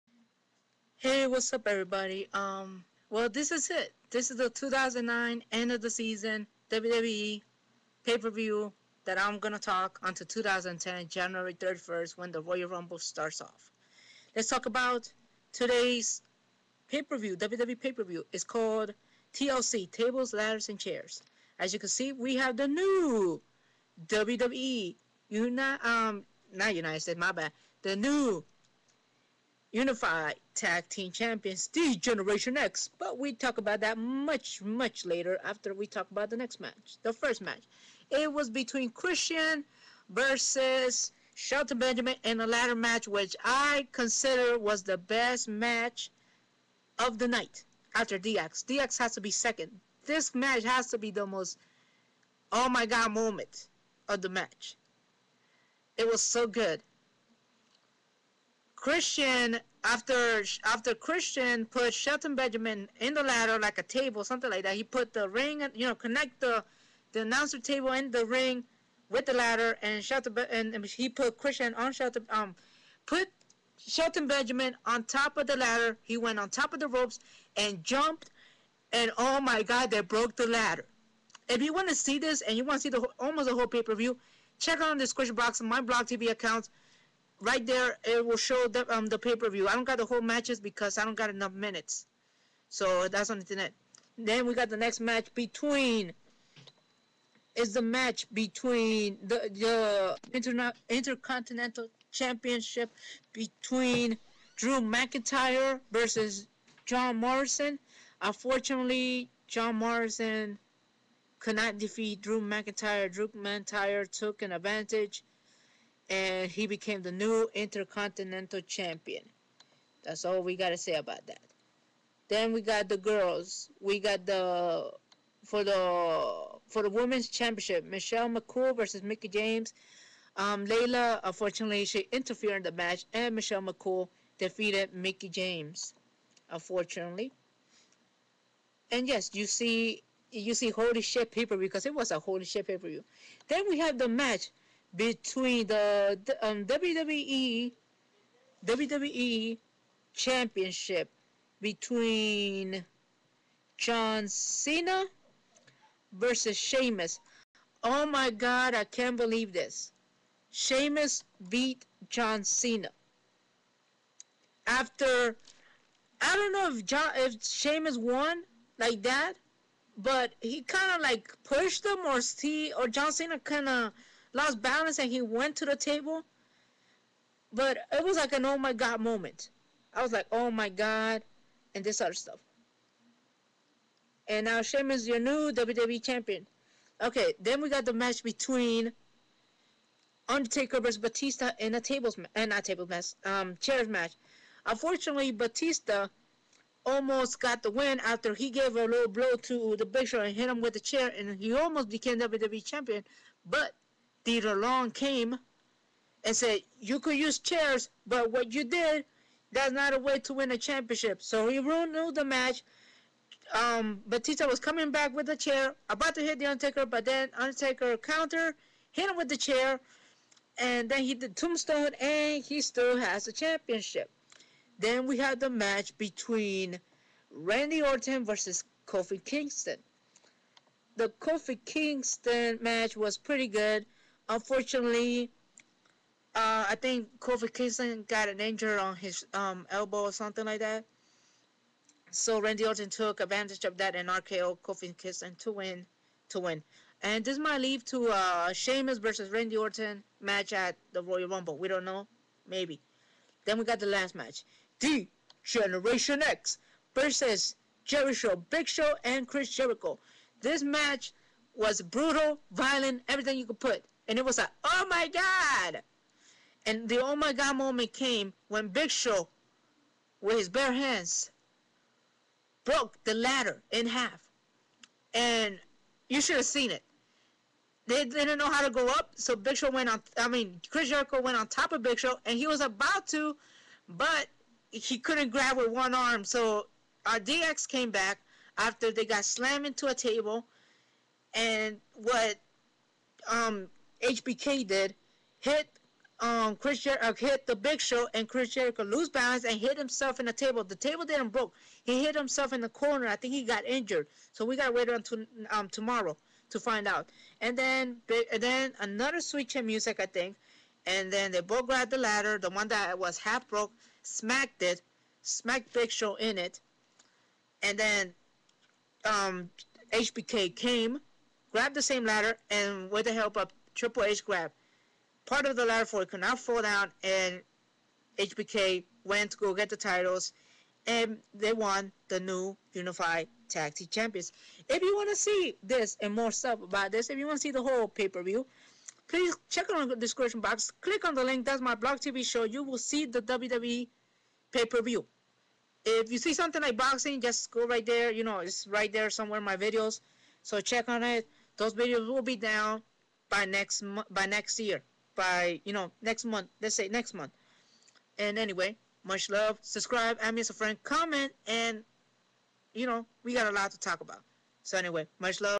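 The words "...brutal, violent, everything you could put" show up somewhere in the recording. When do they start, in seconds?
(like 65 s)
261 s.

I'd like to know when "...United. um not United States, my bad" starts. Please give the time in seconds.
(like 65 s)
25 s.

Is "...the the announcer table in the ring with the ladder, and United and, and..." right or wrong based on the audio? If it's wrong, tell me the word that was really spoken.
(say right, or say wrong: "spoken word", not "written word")
wrong: "Shelton", not "United".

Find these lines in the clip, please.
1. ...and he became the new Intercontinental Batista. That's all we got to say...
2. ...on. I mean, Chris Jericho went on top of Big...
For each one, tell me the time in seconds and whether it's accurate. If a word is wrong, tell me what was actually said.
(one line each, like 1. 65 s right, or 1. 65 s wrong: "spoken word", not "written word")
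1. 116 s wrong: "Champion", not "Batista"
2. 279 s right.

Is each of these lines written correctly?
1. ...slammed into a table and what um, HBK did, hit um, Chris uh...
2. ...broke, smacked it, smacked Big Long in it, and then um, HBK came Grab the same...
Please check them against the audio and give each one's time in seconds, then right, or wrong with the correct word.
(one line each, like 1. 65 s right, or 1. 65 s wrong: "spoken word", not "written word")
1. 289 s right
2. 313 s wrong: "Show", not "Long".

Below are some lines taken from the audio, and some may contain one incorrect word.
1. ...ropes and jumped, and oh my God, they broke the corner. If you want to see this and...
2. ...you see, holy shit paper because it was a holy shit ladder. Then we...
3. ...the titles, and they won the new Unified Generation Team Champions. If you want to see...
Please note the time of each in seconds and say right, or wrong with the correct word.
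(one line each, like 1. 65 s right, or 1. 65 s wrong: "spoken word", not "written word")
1. 76 s wrong: "ladder", not "corner"
2. 140 s wrong: "paper", not "ladder"
3. 329 s wrong: "Tag", not "Generation".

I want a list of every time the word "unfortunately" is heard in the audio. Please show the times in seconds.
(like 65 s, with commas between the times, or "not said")
108 s, 131 s, 136 s, 194 s, 234 s.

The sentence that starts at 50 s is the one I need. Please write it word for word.
This match has to be the most oh my god moment of the match.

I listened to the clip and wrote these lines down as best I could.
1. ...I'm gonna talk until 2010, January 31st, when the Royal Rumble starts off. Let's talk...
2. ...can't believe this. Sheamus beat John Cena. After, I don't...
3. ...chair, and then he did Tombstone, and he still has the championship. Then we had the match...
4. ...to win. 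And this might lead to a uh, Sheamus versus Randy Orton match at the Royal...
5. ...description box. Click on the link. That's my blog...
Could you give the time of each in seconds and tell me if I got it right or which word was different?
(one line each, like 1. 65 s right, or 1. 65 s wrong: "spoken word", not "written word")
1. 9 s right
2. 158 s right
3. 219 s right
4. 246 s right
5. 339 s right.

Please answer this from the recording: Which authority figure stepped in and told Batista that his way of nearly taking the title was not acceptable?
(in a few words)
Teddy Long.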